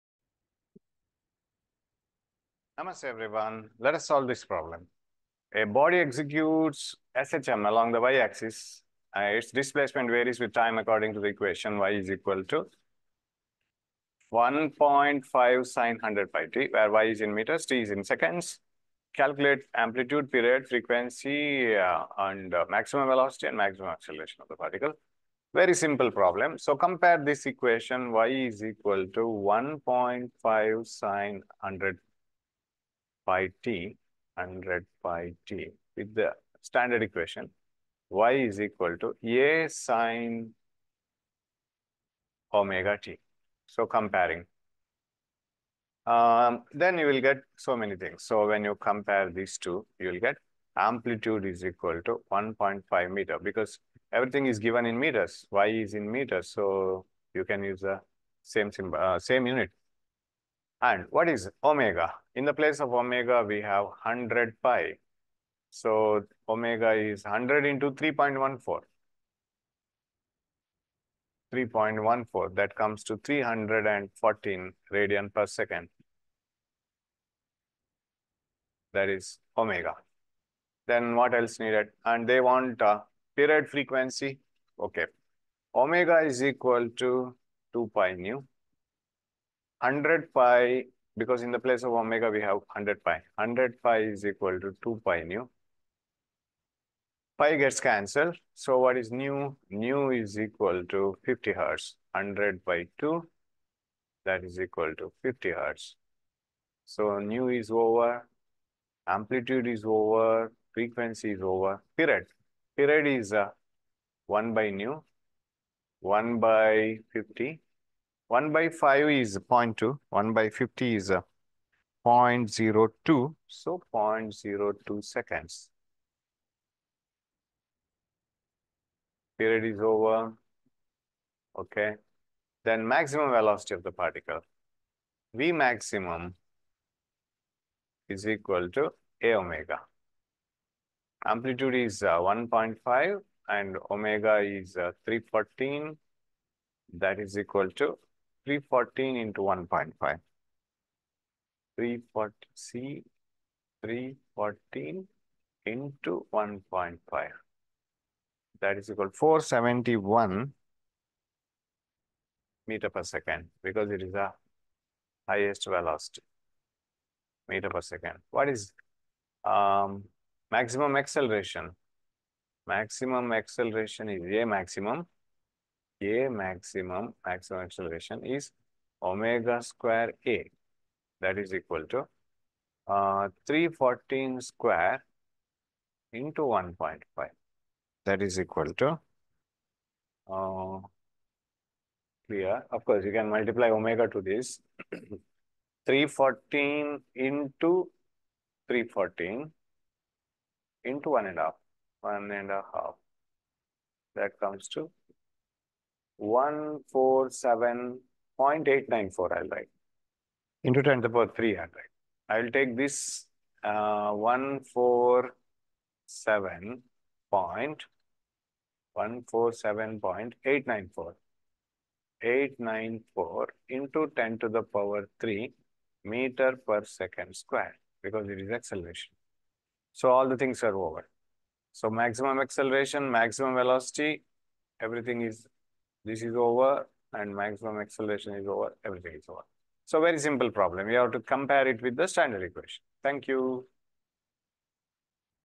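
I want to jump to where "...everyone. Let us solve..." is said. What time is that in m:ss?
0:03.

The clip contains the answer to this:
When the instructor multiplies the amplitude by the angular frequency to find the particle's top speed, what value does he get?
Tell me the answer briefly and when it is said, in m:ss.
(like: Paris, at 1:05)
471 meter per second, at 2:39.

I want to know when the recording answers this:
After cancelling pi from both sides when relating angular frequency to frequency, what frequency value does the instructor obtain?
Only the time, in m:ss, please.
1:39.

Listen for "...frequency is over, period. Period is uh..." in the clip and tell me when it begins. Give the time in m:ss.
1:50.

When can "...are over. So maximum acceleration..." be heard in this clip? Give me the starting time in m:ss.
3:50.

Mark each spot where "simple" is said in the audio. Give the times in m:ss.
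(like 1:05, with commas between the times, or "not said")
0:25, 4:00.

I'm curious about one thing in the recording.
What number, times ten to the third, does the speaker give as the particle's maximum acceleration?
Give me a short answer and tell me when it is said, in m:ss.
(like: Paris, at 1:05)
147.894, at 3:26.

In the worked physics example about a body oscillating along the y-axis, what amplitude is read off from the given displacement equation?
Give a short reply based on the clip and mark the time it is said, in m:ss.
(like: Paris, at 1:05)
1.5 meter, at 0:50.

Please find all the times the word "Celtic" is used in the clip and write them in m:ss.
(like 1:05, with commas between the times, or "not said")
not said.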